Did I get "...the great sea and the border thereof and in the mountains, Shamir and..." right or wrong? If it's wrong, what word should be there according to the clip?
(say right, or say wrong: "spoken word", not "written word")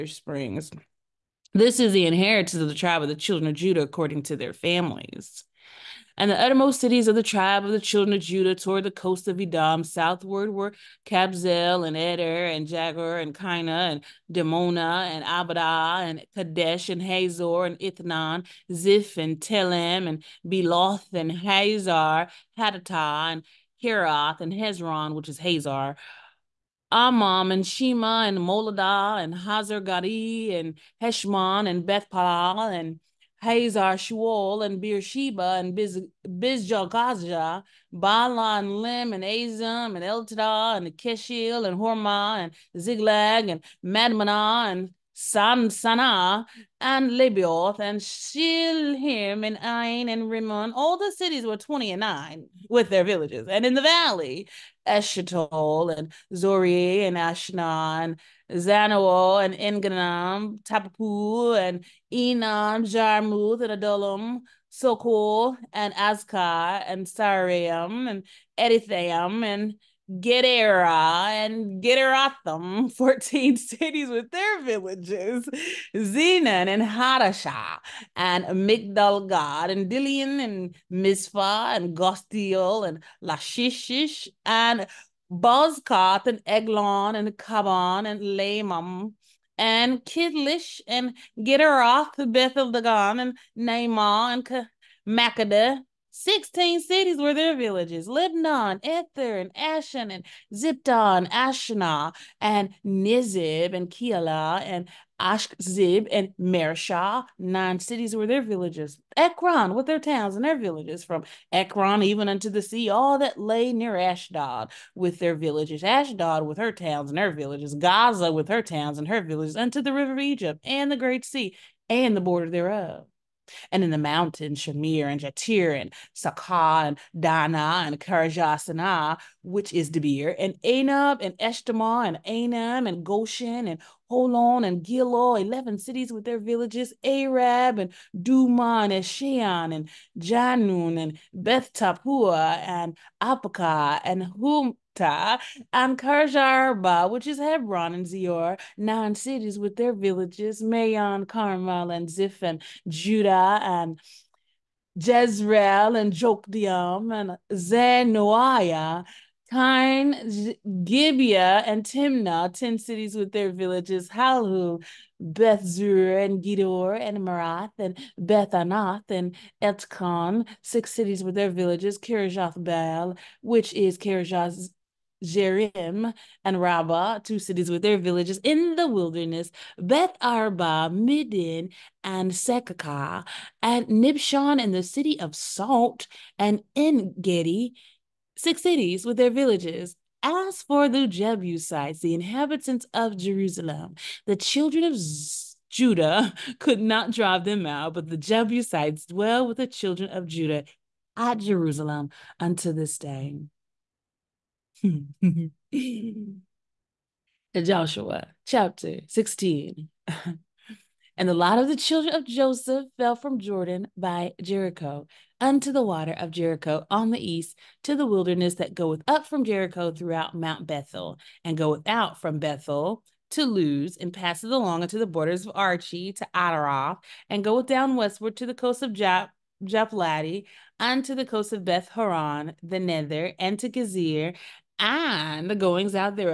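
right.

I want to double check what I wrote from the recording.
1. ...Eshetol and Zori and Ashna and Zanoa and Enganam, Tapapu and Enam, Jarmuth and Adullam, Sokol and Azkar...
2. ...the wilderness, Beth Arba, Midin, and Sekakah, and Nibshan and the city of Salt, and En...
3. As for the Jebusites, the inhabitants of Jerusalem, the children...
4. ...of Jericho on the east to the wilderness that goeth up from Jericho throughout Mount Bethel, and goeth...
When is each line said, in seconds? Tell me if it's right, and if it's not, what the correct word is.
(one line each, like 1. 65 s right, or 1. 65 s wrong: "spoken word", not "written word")
1. 54 s right
2. 178 s right
3. 190 s right
4. 216 s right.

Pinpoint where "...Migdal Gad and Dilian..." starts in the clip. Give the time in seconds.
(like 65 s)
78 s.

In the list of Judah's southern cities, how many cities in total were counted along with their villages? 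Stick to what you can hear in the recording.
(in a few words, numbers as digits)
29.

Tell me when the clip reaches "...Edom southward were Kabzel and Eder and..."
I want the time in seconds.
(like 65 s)
9 s.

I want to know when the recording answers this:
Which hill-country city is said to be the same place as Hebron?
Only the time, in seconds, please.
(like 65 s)
145 s.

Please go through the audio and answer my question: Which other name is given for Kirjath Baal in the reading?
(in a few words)
Kirjath Jerim.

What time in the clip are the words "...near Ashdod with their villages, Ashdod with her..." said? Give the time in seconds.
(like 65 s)
113 s.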